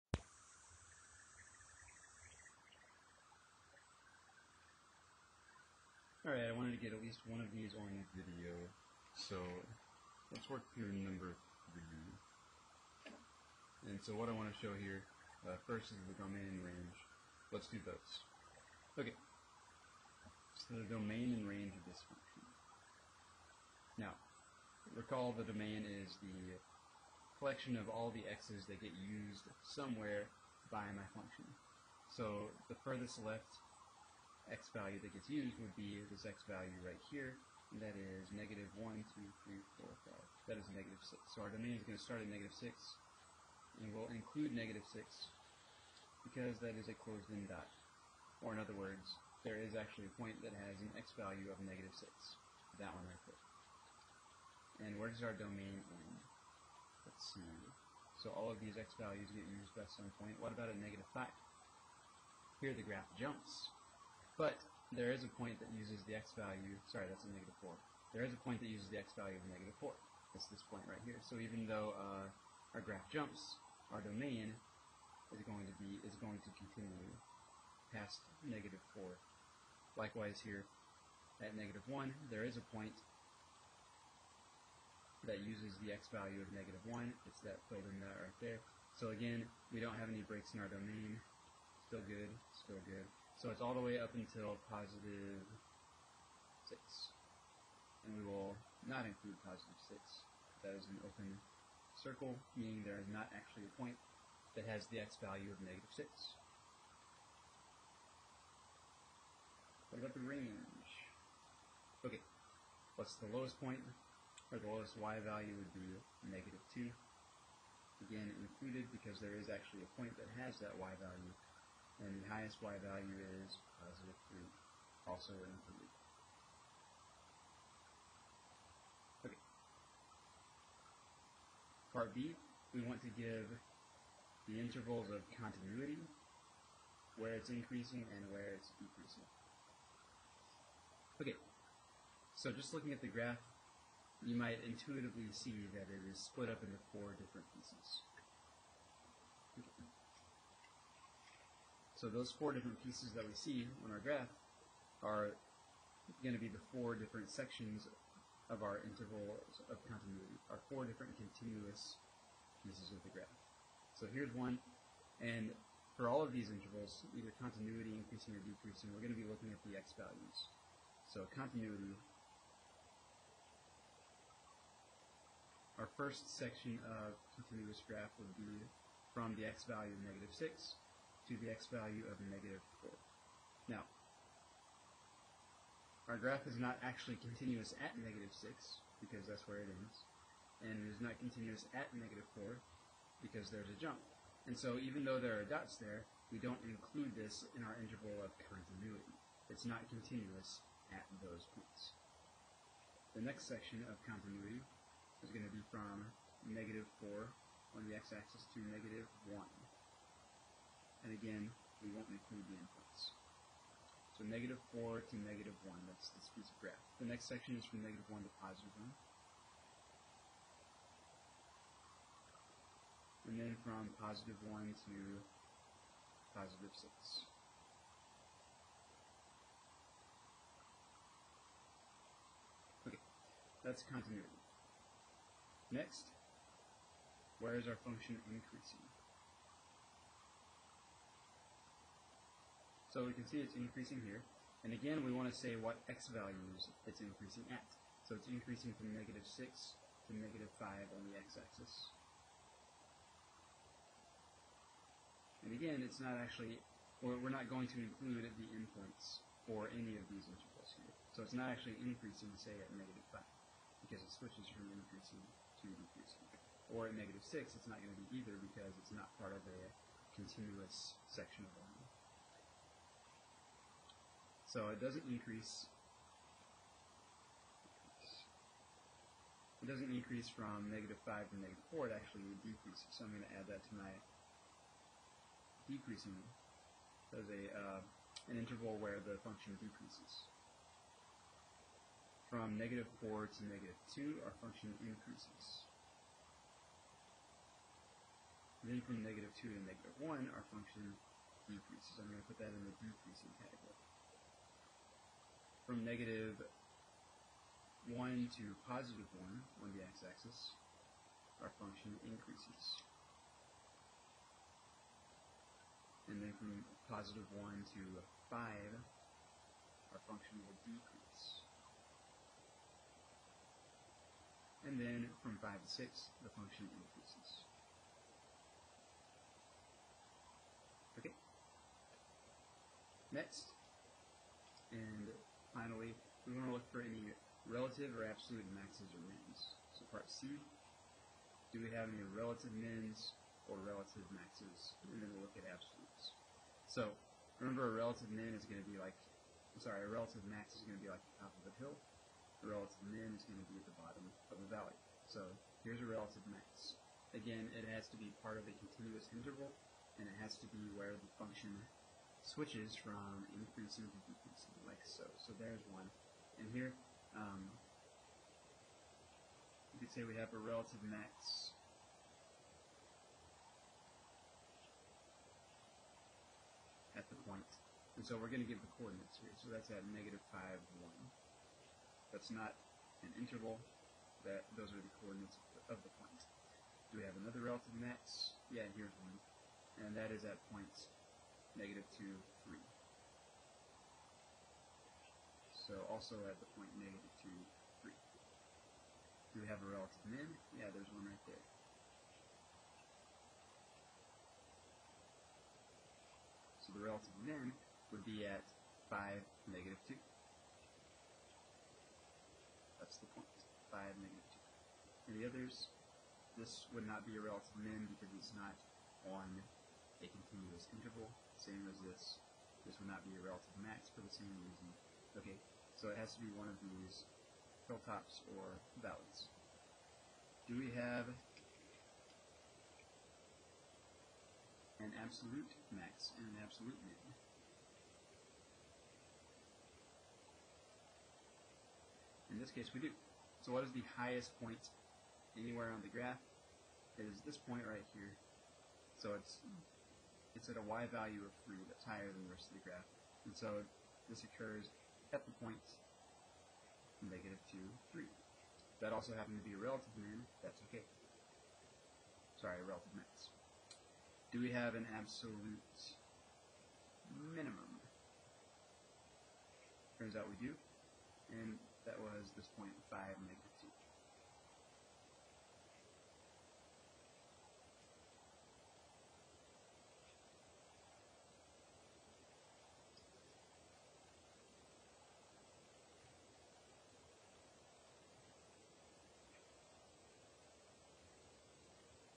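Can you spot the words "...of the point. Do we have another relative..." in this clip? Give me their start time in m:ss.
6:25.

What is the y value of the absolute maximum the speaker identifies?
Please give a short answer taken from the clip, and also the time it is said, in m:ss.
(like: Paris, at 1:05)
3, at 7:30.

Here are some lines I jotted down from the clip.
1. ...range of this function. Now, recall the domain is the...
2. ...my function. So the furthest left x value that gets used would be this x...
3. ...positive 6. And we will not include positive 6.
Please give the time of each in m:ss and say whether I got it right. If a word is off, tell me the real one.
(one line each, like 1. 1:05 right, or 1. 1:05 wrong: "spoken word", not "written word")
1. 0:21 right
2. 0:30 right
3. 1:34 right.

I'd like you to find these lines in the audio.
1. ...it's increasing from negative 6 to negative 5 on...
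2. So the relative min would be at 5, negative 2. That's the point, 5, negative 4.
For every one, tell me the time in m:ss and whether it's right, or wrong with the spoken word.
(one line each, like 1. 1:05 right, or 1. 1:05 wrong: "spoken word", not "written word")
1. 4:08 right
2. 6:46 wrong: "2", not "4".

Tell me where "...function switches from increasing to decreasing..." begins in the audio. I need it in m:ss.
6:01.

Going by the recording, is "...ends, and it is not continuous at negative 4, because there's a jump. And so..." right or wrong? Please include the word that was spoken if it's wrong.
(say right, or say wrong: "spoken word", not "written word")
right.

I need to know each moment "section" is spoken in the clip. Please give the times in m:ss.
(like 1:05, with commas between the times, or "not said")
2:37, 2:56, 3:23, 3:37, 4:31.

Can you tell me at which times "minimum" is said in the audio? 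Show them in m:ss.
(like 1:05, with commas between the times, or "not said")
7:47.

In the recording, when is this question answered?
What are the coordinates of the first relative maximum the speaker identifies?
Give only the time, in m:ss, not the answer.
6:19.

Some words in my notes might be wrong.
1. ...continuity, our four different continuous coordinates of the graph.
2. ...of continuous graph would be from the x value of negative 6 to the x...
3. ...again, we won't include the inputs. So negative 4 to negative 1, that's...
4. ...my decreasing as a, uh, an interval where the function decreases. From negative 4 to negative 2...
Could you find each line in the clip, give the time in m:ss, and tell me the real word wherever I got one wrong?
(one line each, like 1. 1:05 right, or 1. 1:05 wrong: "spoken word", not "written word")
1. 2:39 wrong: "pieces", not "coordinates"
2. 2:56 right
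3. 3:31 right
4. 4:43 right.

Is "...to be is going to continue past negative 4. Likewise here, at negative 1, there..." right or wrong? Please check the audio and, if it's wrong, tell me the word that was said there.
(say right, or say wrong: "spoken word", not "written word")
right.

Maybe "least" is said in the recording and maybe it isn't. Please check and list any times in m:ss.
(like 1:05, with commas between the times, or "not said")
0:06.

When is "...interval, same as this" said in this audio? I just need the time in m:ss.
7:00.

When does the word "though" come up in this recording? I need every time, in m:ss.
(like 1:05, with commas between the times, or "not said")
1:11, 3:15.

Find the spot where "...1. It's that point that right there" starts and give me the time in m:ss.
1:26.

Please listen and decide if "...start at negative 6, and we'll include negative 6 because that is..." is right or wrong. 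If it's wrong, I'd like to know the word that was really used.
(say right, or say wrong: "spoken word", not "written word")
right.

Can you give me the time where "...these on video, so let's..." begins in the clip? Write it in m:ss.
0:07.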